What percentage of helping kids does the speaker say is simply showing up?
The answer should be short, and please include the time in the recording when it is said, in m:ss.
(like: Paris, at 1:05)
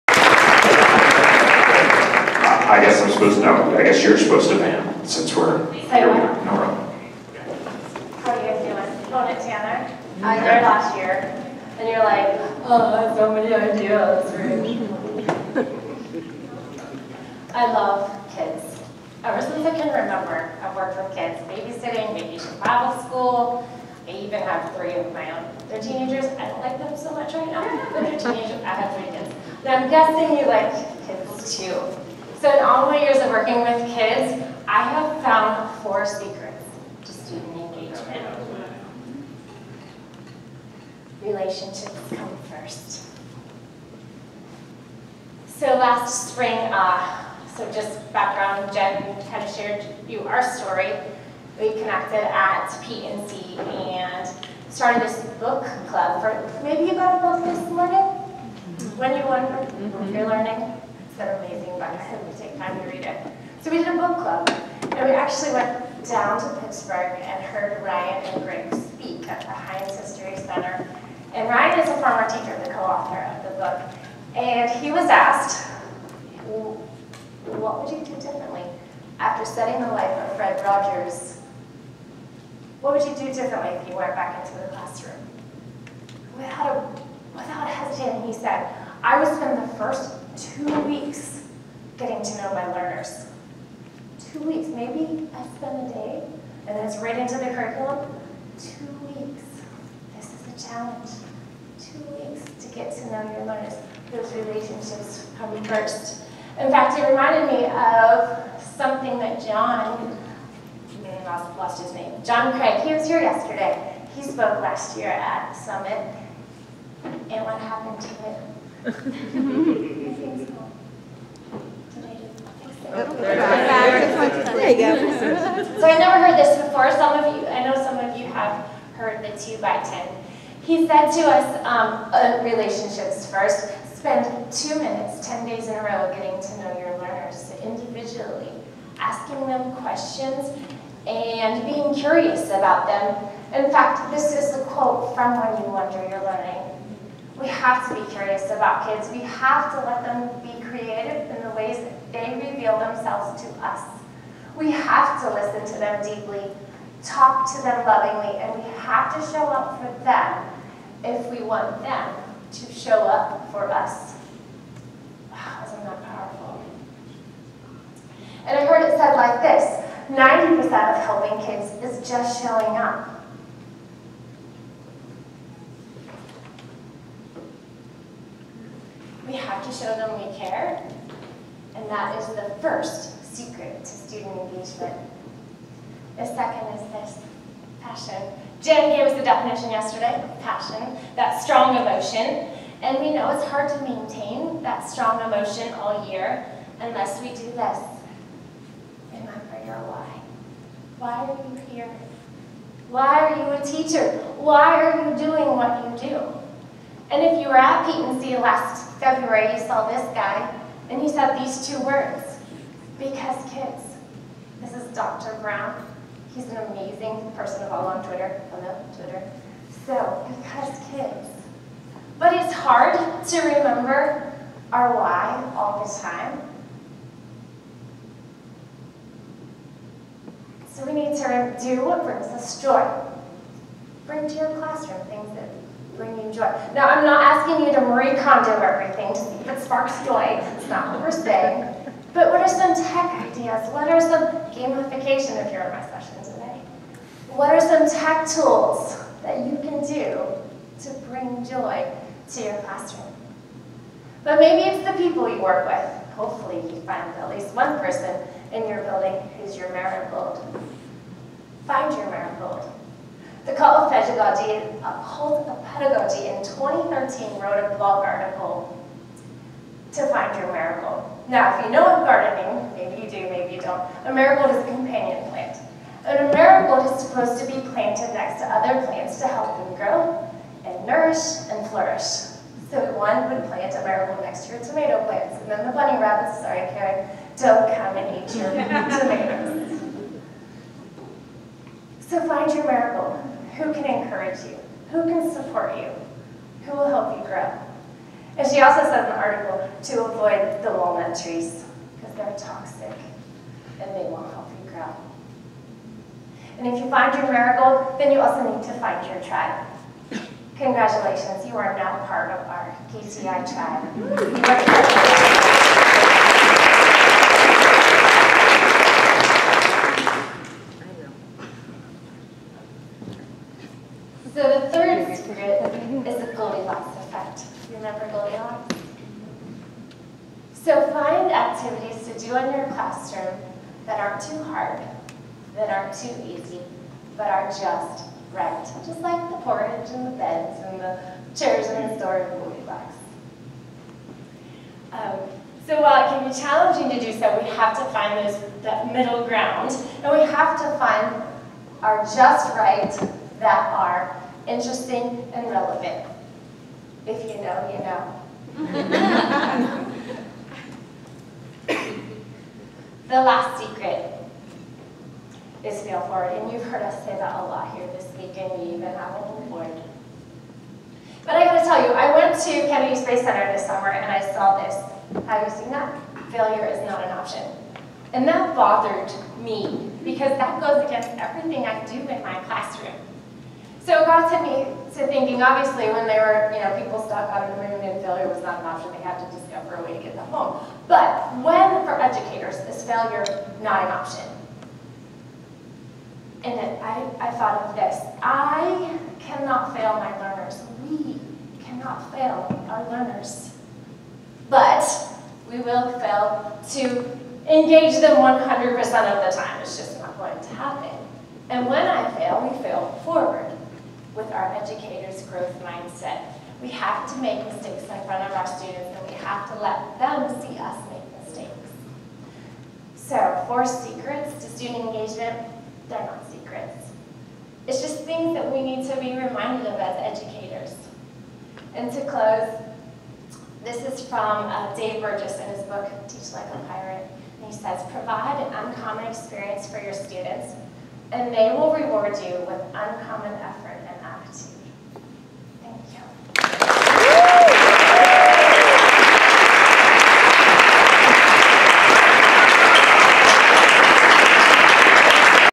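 90%, at 2:50.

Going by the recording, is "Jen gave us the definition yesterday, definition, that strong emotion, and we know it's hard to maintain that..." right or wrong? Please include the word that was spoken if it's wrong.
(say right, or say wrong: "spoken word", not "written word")
wrong: "passion", not "definition".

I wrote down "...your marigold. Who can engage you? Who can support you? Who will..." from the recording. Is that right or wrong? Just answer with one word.
wrong.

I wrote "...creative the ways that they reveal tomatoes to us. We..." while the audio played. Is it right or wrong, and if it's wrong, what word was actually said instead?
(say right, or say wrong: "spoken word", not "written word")
wrong: "themselves", not "tomatoes".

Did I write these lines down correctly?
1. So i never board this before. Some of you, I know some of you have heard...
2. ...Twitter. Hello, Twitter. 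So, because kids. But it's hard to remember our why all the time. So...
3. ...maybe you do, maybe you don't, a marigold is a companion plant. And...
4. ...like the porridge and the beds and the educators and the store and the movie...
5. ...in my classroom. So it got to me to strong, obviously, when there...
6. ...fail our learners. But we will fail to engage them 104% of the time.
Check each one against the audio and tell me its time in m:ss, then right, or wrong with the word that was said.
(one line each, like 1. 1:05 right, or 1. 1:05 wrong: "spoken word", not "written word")
1. 2:05 wrong: "heard", not "board"
2. 3:38 right
3. 4:32 right
4. 5:39 wrong: "chairs", not "educators"
5. 6:22 wrong: "thinking", not "strong"
6. 6:42 wrong: "100", not "104".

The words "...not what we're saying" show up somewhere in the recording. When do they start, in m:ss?
4:00.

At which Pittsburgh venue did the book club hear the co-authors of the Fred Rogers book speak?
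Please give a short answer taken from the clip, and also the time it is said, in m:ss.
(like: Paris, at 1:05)
Heinz History Center, at 1:09.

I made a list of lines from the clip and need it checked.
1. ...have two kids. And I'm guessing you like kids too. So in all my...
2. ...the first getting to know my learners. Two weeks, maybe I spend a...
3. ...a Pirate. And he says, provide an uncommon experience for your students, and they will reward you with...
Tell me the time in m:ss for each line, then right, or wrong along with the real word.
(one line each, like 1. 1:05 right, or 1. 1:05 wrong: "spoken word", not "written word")
1. 0:28 wrong: "three", not "two"
2. 1:29 right
3. 7:16 right.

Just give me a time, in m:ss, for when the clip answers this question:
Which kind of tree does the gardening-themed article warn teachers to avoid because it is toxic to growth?
5:00.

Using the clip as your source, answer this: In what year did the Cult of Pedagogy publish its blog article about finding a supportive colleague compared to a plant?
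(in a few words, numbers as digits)
2013.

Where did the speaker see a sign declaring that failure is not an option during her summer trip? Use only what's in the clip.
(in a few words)
Kennedy Space Center.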